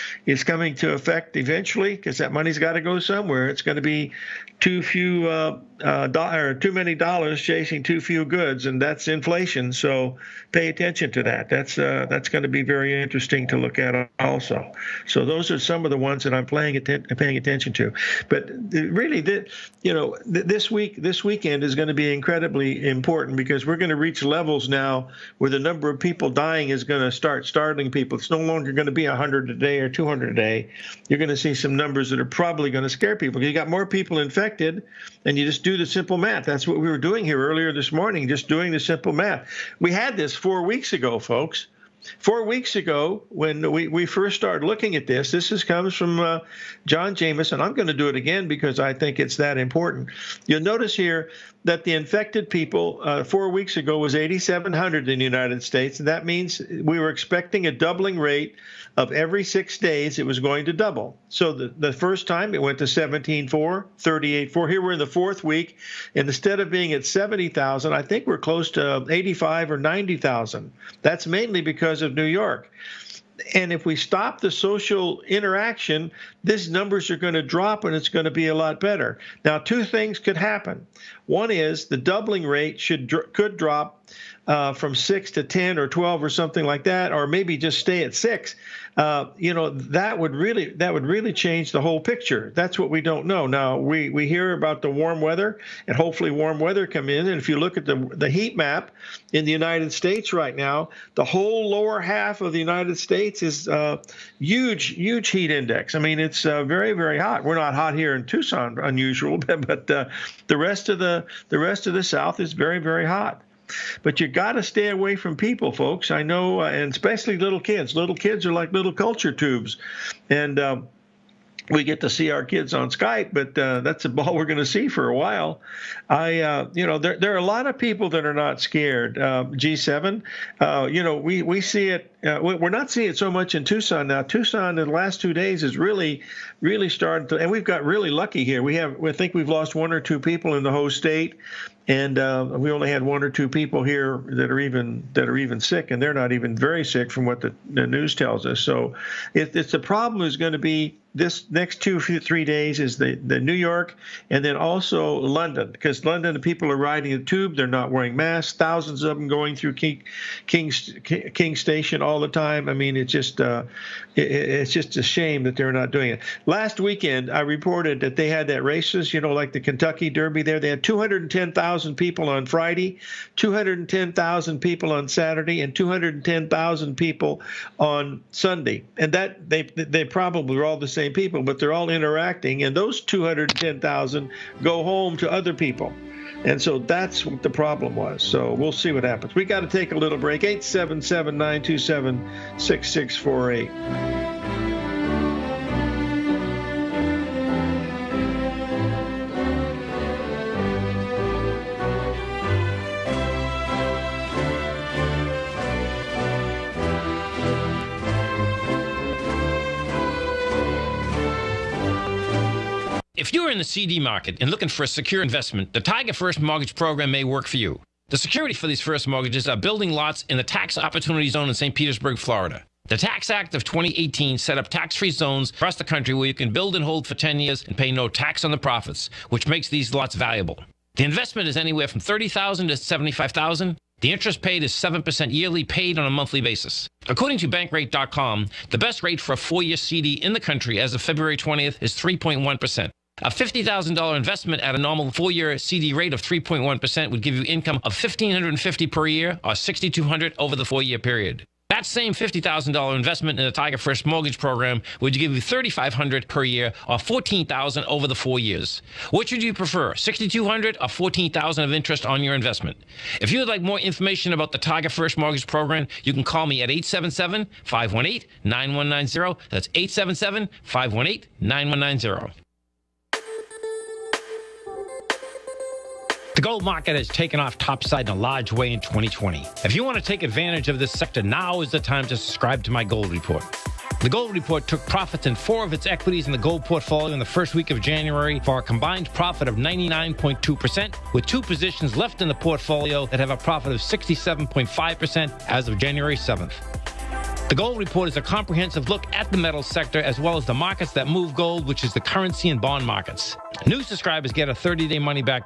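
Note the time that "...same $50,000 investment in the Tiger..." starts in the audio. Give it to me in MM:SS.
04:11.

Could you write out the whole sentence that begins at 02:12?
Uh, we're not seeing it so much in Tucson now.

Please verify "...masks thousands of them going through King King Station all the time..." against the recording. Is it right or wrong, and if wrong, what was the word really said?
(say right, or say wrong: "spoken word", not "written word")
right.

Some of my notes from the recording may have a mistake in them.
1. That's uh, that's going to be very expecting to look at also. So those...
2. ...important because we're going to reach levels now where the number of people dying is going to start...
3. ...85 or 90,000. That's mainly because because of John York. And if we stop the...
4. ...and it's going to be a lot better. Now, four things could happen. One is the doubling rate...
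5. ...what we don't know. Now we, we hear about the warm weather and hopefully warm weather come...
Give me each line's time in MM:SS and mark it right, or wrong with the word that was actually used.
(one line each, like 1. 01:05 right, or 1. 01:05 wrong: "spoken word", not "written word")
1. 00:11 wrong: "interesting", not "expecting"
2. 00:22 right
3. 01:09 wrong: "New", not "John"
4. 01:17 wrong: "two", not "four"
5. 01:32 right.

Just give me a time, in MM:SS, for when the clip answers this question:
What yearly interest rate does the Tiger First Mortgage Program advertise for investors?
03:54.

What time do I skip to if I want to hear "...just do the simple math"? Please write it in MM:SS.
00:35.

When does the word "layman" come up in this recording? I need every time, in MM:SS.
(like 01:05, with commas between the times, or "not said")
not said.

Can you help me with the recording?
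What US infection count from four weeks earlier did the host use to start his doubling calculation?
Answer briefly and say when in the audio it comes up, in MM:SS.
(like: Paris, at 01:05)
8,700, at 00:54.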